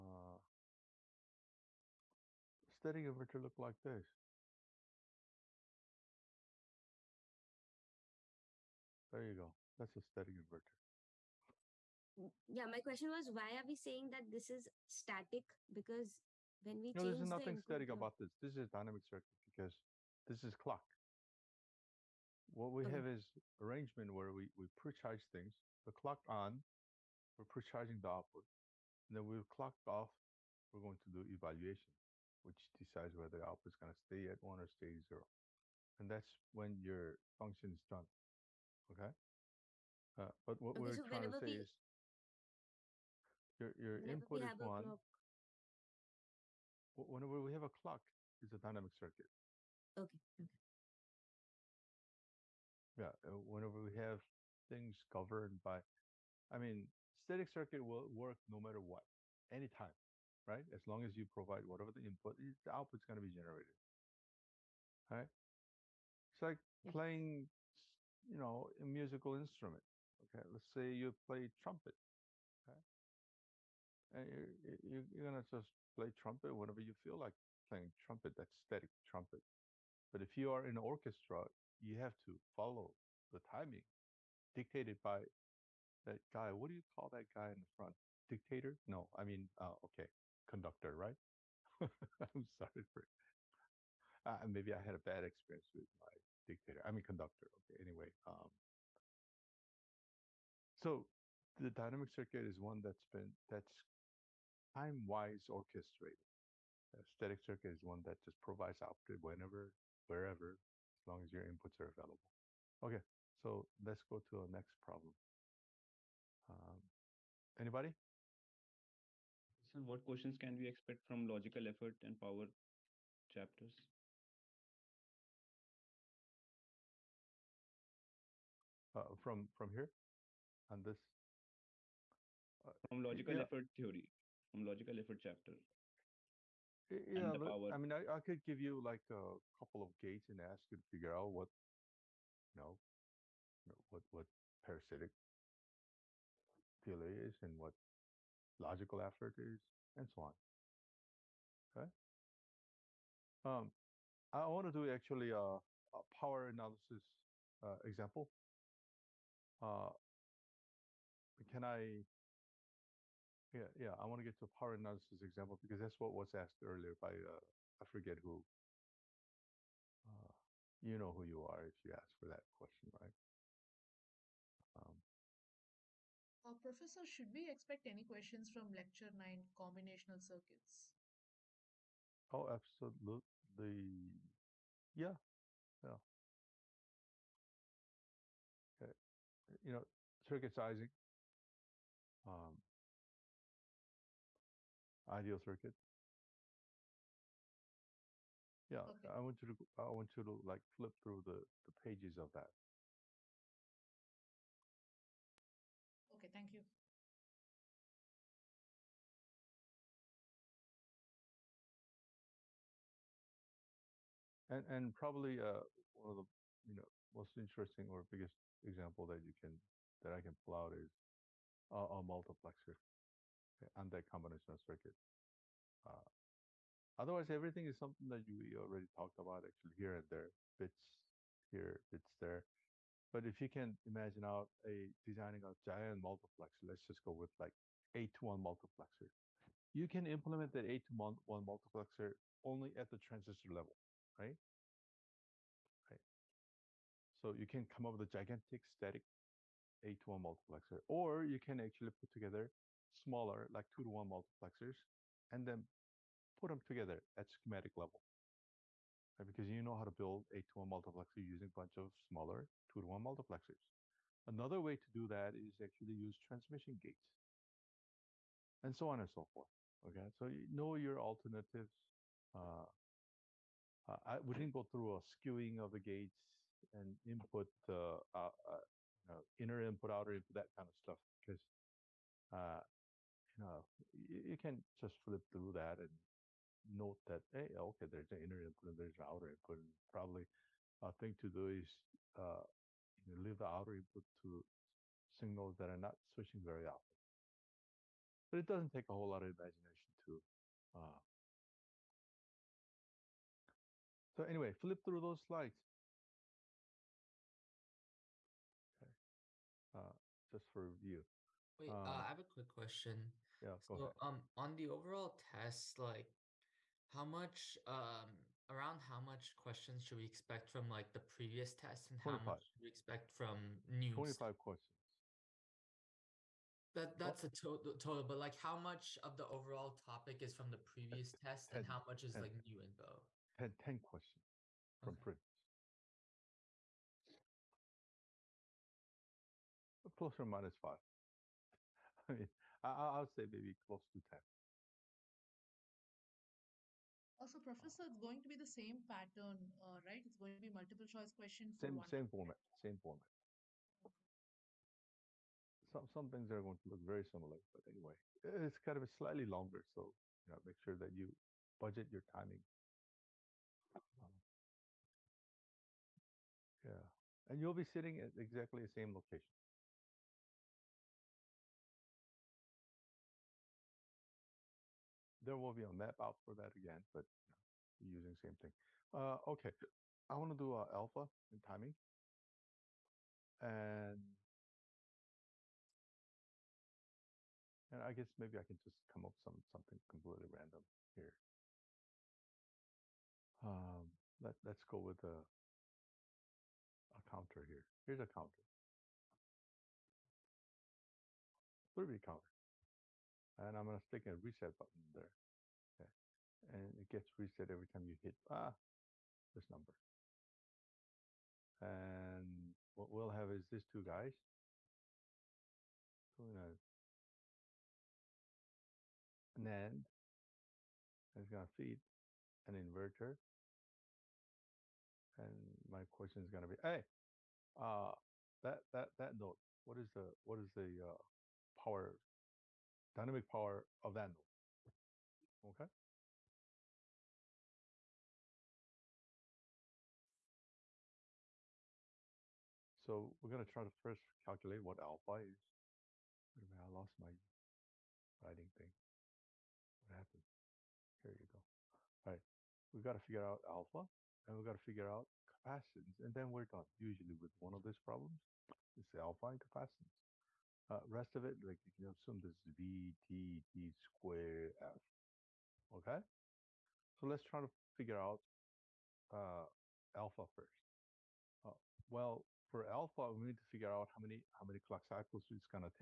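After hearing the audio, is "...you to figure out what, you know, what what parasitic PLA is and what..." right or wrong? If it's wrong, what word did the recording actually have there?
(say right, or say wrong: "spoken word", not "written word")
right.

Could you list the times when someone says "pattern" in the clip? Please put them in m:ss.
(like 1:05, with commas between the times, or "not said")
5:48.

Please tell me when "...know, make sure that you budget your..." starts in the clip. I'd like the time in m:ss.
6:00.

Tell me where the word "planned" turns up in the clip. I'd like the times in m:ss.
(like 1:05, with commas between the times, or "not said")
not said.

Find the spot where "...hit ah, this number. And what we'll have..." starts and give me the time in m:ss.
6:48.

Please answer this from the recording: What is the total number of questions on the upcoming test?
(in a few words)
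25.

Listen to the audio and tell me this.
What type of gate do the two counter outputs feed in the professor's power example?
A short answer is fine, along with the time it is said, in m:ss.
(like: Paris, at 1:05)
NAND, at 6:59.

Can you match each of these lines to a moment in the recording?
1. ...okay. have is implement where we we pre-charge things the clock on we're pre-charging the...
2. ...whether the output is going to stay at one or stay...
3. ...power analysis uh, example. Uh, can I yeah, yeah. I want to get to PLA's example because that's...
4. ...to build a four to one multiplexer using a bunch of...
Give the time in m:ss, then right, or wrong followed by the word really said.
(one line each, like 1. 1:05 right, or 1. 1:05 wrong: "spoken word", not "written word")
1. 0:22 wrong: "arrangement", not "implement"
2. 0:33 right
3. 2:36 wrong: "Paranasa", not "PLA"
4. 4:19 wrong: "two", not "four".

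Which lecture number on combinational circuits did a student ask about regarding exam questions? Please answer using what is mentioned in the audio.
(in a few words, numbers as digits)
9.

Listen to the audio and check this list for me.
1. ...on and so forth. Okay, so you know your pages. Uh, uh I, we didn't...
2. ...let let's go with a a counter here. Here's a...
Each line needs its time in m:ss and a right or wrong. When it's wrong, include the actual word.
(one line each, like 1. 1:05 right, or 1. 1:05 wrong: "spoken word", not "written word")
1. 4:28 wrong: "alternatives", not "pages"
2. 6:34 right.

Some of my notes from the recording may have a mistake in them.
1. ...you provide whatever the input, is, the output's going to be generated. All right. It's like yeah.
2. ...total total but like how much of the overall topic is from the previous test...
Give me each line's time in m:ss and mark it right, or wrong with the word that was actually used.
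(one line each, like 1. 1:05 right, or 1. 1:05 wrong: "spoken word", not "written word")
1. 1:01 right
2. 5:27 right.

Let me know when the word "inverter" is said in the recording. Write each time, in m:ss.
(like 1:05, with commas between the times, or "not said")
0:03, 0:10, 7:02.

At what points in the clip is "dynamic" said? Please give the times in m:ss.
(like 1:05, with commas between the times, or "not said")
0:18, 0:48, 1:41, 7:12.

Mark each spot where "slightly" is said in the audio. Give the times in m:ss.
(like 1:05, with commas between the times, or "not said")
5:58.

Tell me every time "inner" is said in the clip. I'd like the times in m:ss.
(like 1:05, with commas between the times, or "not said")
4:39, 4:48.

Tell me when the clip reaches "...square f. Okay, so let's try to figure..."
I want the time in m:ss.
7:43.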